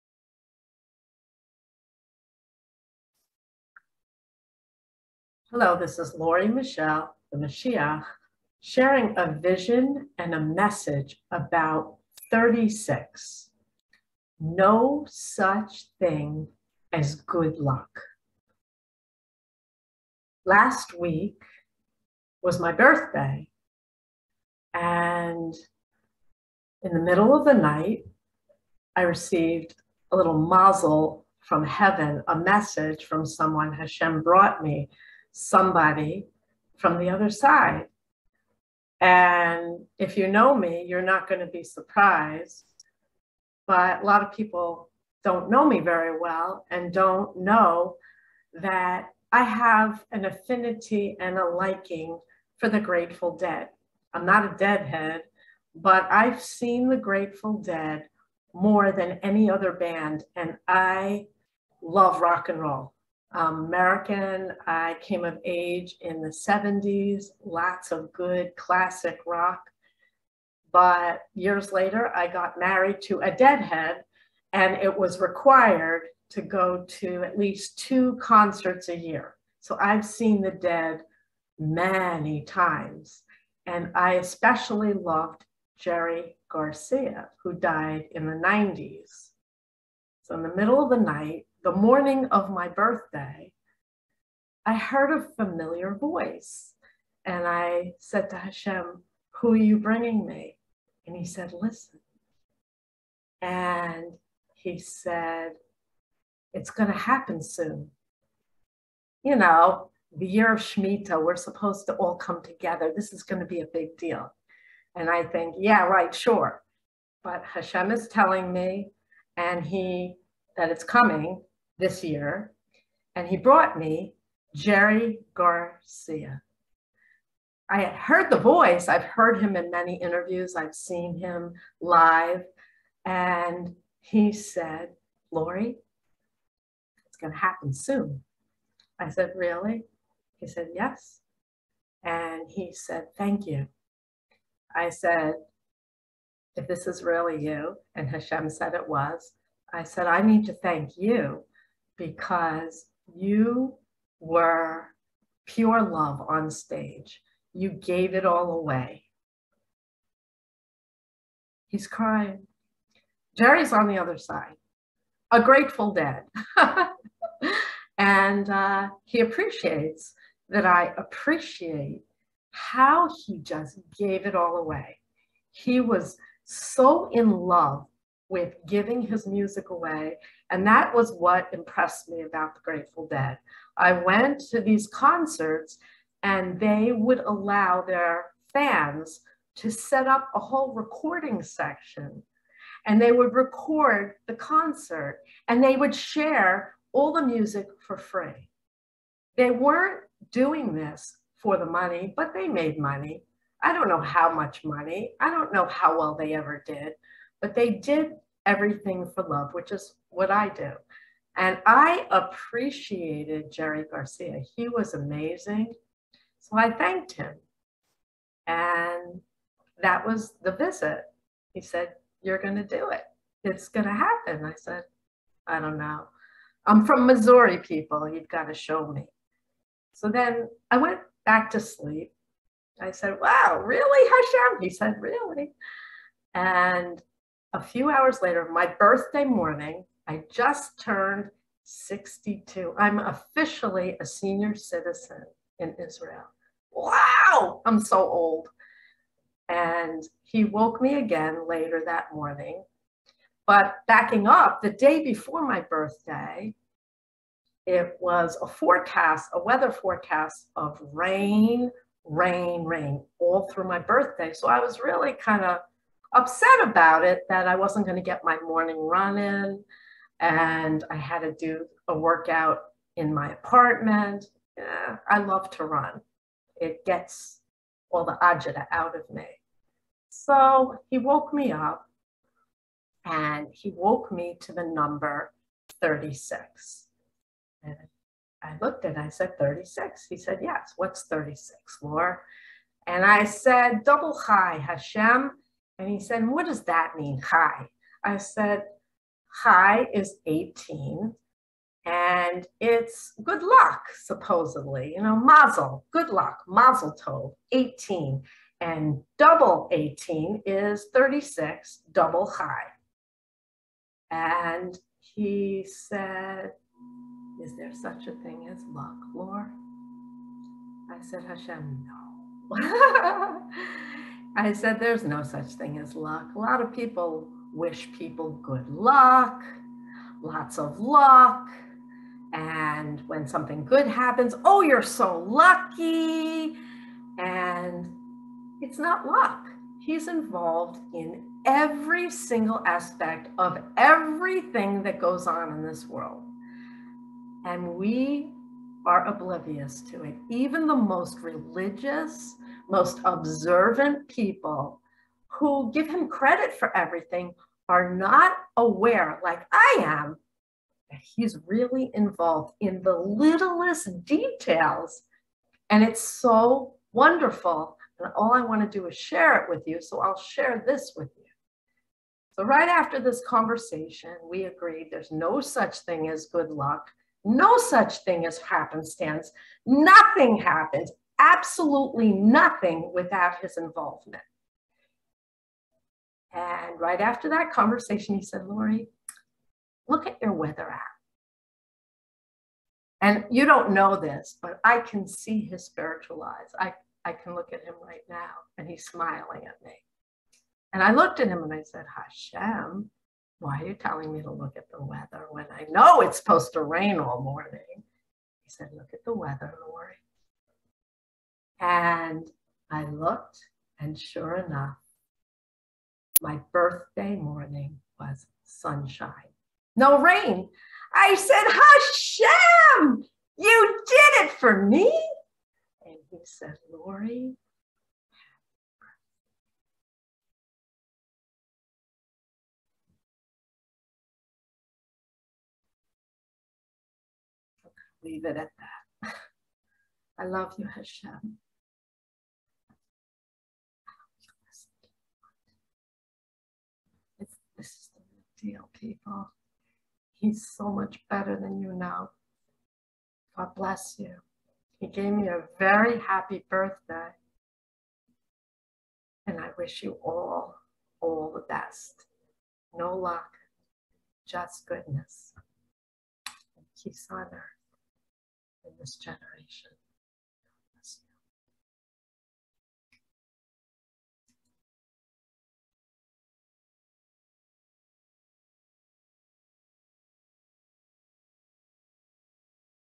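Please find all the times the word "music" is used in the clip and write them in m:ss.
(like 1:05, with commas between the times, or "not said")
2:59, 3:17.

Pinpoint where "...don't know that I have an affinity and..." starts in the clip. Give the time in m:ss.
0:46.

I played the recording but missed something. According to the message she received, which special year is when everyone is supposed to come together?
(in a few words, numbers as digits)
Shemitah.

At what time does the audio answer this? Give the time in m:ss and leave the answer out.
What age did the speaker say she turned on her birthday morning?
4:01.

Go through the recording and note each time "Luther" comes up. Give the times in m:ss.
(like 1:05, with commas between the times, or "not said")
not said.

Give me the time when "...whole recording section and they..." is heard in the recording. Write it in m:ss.
3:10.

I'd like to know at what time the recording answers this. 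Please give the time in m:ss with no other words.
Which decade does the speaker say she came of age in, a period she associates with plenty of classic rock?
1:06.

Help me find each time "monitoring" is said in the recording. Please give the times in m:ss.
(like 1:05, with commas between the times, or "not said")
not said.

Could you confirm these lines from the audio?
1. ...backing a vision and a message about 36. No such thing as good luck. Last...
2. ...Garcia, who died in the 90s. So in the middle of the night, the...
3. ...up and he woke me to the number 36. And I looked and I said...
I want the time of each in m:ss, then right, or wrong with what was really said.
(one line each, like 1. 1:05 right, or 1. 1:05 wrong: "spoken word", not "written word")
1. 0:08 wrong: "sharing", not "backing"
2. 1:26 right
3. 4:41 right.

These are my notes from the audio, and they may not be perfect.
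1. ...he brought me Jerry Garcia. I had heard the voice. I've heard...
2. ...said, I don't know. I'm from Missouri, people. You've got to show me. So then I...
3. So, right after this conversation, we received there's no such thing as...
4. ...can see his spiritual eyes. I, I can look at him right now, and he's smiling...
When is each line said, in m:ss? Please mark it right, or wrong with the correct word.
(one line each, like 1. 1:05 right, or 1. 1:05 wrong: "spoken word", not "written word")
1. 2:03 right
2. 3:44 right
3. 6:12 wrong: "agreed", not "received"
4. 6:34 right.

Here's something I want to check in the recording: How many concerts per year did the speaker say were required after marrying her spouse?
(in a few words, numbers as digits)
2.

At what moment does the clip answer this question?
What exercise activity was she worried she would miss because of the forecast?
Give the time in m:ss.
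4:28.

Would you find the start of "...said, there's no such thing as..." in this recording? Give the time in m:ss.
5:24.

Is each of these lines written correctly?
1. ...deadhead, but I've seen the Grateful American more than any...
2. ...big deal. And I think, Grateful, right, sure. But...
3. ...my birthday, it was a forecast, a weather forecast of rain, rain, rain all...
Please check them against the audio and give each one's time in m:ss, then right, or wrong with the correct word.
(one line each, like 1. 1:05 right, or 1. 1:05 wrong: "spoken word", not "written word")
1. 0:54 wrong: "Dead", not "American"
2. 1:53 wrong: "Yeah", not "Grateful"
3. 4:15 right.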